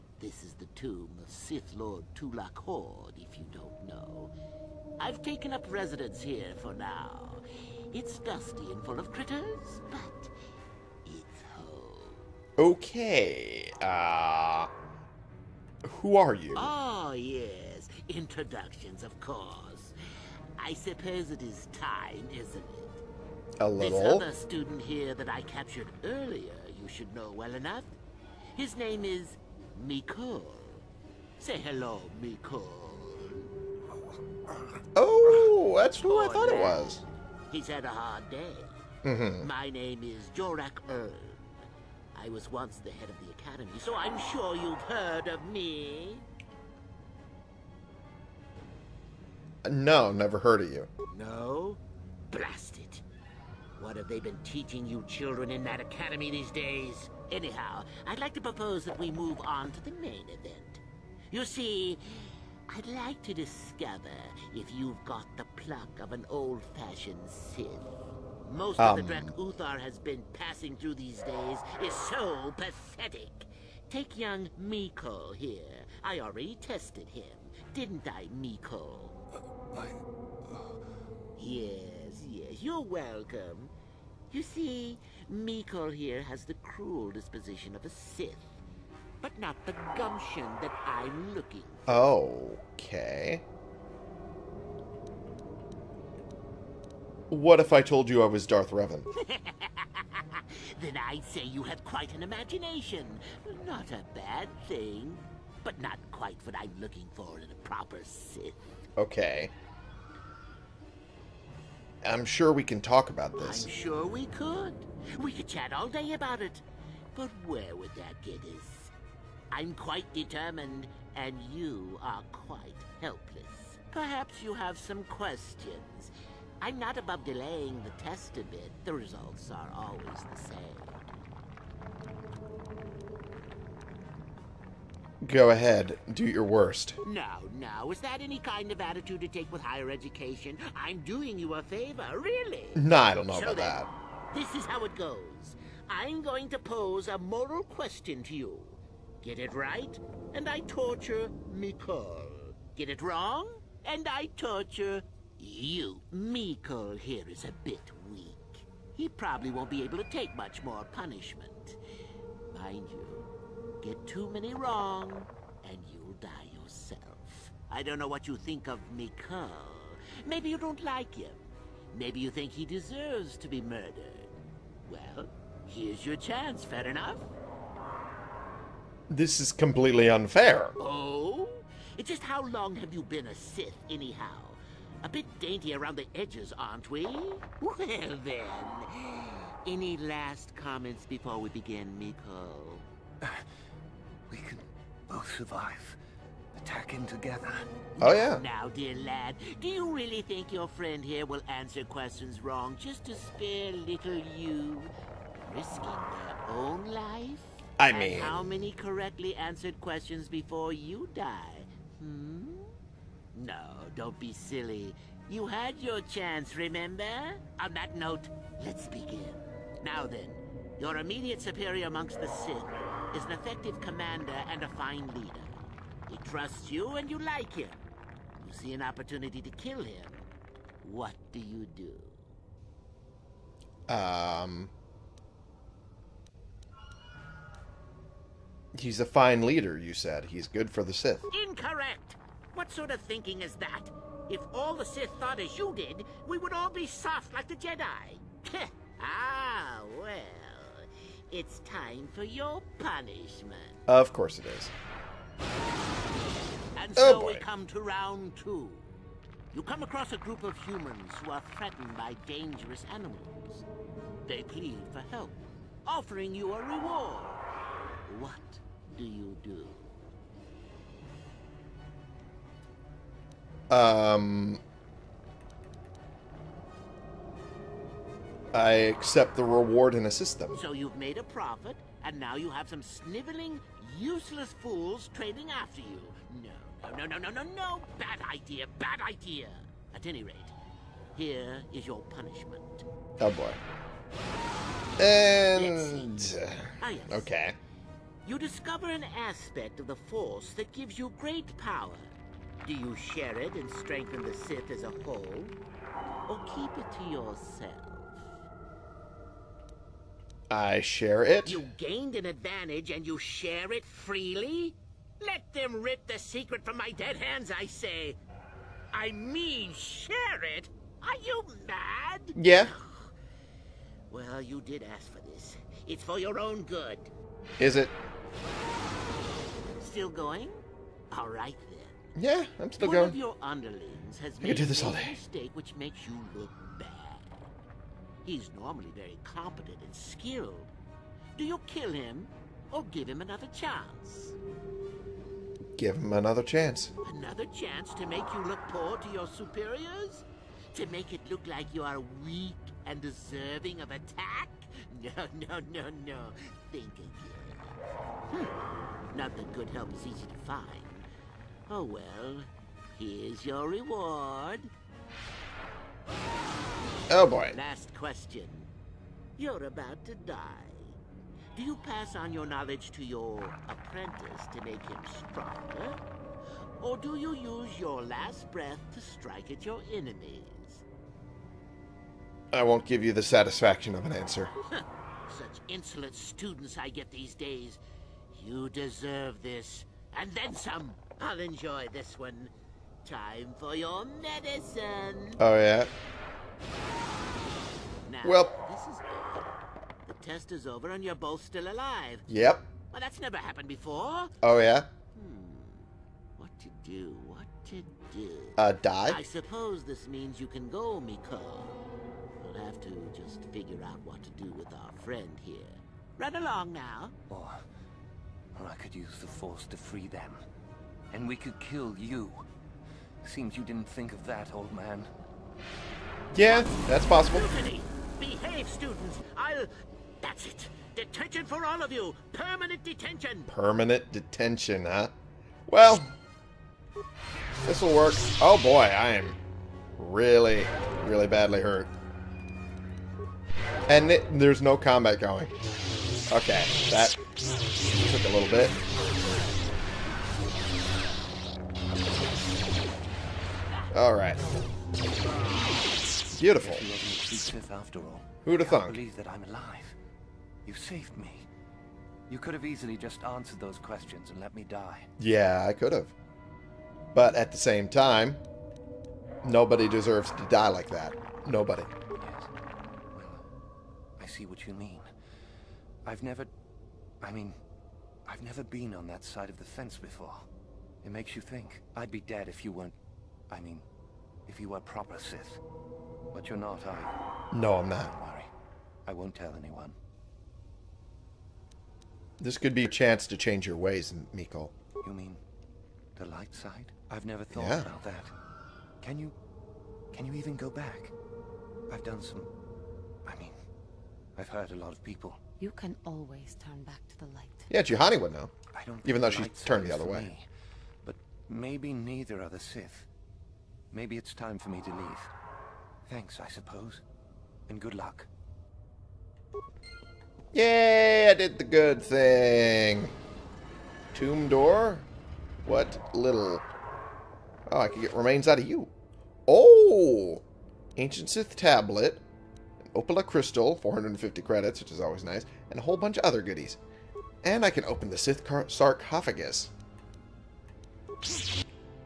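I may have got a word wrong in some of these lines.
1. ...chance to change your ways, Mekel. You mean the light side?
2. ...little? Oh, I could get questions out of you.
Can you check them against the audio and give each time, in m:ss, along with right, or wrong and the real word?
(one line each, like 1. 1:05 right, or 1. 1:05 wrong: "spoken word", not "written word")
1. 8:12 right
2. 8:46 wrong: "remains", not "questions".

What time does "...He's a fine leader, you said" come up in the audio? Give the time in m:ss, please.
3:58.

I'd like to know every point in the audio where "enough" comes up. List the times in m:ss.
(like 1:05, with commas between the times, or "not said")
0:27, 2:56.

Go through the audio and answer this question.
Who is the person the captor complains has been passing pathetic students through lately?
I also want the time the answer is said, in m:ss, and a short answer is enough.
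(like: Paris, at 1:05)
Uthar, at 1:09.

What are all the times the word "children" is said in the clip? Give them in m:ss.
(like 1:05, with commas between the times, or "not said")
0:55.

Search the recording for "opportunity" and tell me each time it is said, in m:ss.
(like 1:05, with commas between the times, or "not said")
3:48.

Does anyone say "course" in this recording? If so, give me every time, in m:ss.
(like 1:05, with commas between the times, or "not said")
0:19, 4:14.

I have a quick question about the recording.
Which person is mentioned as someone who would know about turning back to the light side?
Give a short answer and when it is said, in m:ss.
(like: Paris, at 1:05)
Juhani, at 8:27.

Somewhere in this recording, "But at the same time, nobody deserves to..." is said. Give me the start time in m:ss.
7:47.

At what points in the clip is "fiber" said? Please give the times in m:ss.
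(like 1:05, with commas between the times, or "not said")
not said.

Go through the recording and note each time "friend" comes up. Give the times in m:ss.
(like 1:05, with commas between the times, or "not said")
3:20, 6:55.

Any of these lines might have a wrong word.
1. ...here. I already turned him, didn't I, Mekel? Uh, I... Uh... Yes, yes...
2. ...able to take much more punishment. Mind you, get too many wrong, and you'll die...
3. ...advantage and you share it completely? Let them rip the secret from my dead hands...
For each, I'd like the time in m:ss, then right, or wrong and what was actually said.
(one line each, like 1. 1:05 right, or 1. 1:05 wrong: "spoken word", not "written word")
1. 1:15 wrong: "tested", not "turned"
2. 2:39 right
3. 5:12 wrong: "freely", not "completely".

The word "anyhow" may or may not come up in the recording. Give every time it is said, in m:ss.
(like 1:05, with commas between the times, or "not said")
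0:57, 3:03.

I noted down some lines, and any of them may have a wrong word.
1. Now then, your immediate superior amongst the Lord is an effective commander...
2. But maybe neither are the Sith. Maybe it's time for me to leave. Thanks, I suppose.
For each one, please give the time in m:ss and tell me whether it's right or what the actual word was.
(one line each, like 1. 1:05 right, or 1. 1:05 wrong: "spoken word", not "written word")
1. 3:39 wrong: "Sith", not "Lord"
2. 8:31 right.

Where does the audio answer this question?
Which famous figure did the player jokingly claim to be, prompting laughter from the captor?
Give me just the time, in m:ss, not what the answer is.
1:38.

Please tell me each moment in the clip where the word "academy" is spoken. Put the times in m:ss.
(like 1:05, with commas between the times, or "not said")
0:43, 0:55.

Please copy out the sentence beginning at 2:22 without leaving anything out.
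No, I don't know so about then, that.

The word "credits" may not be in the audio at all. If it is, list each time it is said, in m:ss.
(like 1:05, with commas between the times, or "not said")
8:54.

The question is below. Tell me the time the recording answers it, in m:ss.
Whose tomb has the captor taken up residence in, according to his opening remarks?
0:02.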